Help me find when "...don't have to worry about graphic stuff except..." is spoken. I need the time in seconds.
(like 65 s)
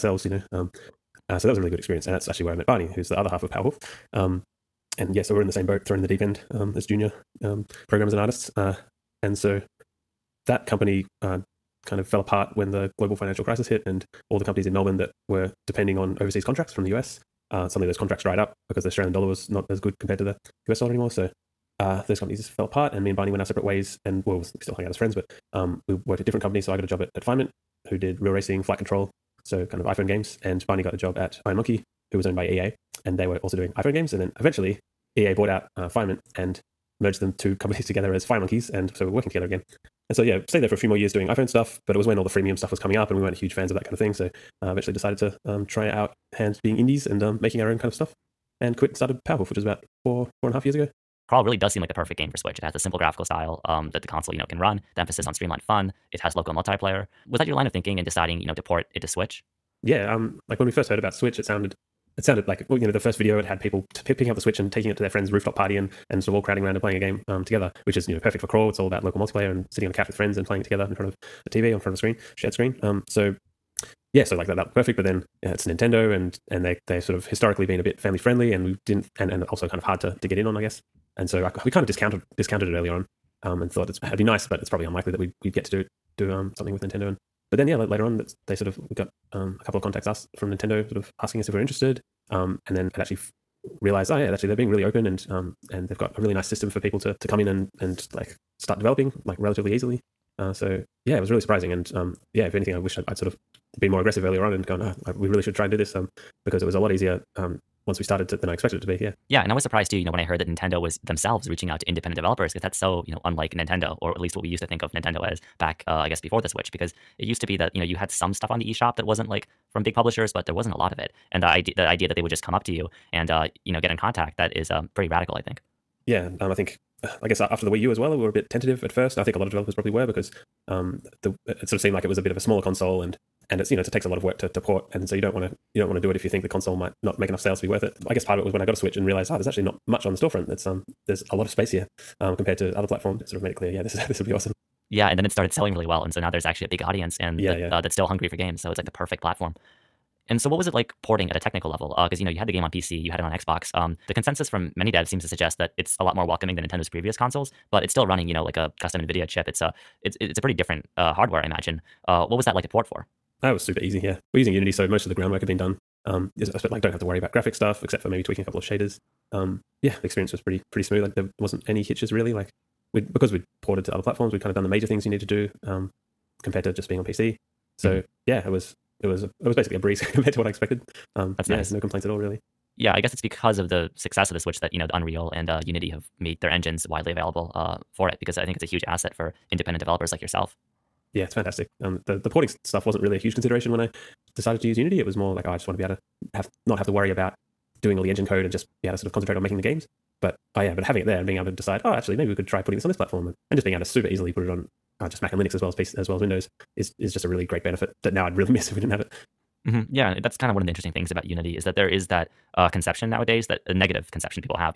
166 s.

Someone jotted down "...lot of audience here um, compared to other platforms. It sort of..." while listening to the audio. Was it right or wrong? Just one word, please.
wrong.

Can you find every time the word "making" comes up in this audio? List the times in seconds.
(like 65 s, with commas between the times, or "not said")
47 s, 199 s.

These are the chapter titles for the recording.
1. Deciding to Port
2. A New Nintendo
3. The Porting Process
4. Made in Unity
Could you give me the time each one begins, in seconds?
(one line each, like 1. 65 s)
1. 50 s
2. 108 s
3. 149 s
4. 182 s.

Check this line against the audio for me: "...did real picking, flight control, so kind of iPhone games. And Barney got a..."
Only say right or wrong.
wrong.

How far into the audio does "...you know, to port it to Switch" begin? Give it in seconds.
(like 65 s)
58 s.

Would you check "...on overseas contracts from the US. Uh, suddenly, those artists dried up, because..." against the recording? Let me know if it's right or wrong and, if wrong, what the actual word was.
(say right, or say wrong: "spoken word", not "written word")
wrong: "contracts", not "artists".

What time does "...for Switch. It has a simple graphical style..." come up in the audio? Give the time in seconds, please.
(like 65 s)
52 s.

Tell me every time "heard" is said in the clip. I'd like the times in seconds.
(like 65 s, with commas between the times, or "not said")
60 s, 110 s.